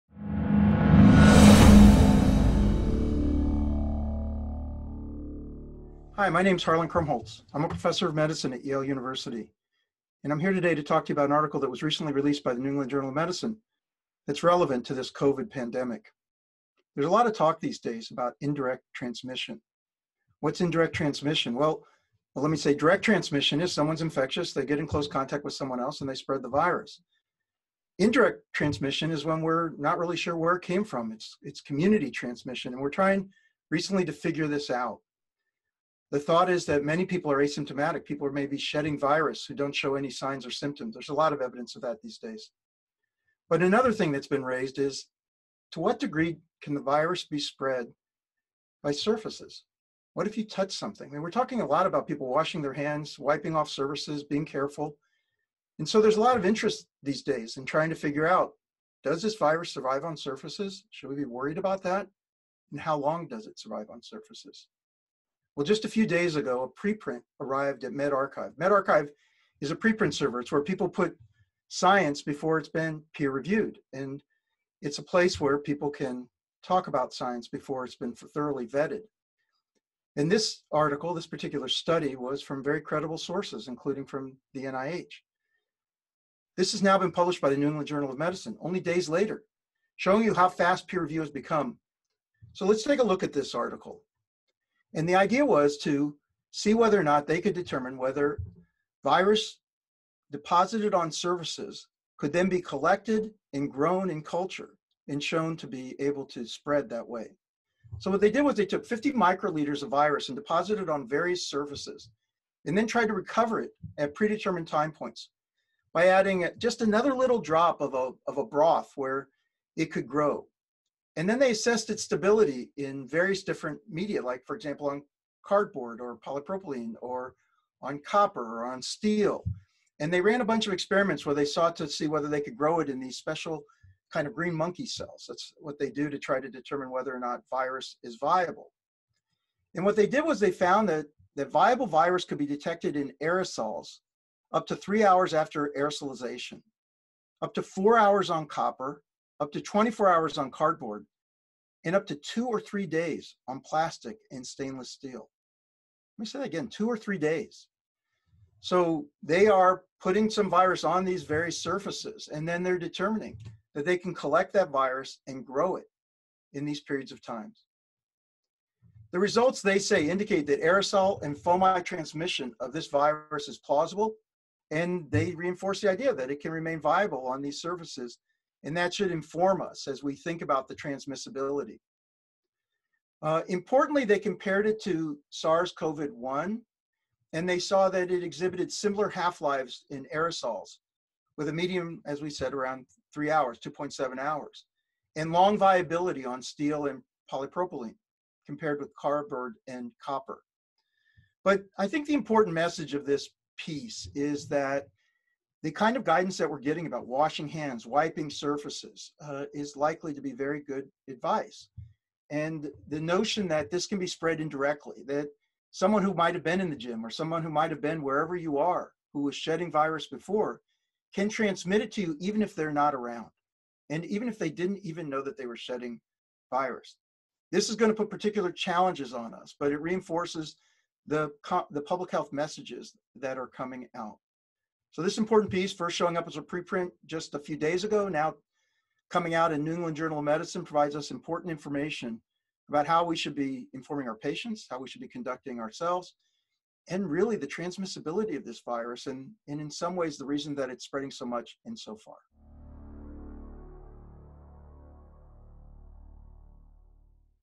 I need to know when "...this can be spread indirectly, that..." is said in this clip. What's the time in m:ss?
3:33.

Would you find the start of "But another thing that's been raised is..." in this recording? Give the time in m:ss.
0:43.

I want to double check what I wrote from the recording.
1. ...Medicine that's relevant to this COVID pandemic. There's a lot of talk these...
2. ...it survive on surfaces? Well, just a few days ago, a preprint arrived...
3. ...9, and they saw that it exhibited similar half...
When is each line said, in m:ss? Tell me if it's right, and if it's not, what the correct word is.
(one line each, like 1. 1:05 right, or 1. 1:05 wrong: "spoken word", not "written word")
1. 0:13 right
2. 1:03 right
3. 3:06 wrong: "1", not "9".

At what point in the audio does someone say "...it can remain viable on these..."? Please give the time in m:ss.
2:56.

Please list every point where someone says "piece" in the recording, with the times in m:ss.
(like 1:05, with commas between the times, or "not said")
3:23, 3:55.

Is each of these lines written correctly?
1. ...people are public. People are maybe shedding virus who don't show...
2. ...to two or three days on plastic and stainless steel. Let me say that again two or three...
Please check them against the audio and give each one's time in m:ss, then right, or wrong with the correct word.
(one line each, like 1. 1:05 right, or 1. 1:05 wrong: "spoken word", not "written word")
1. 0:37 wrong: "asymptomatic", not "public"
2. 2:32 right.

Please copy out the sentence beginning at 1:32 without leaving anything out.
So let's take a look at this article.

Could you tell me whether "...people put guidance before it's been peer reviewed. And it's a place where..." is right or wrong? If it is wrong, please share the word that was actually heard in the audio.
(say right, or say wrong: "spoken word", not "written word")
wrong: "science", not "guidance".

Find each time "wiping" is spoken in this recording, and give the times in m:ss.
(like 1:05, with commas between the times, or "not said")
0:53, 3:27.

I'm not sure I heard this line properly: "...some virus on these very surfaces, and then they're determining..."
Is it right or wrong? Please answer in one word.
right.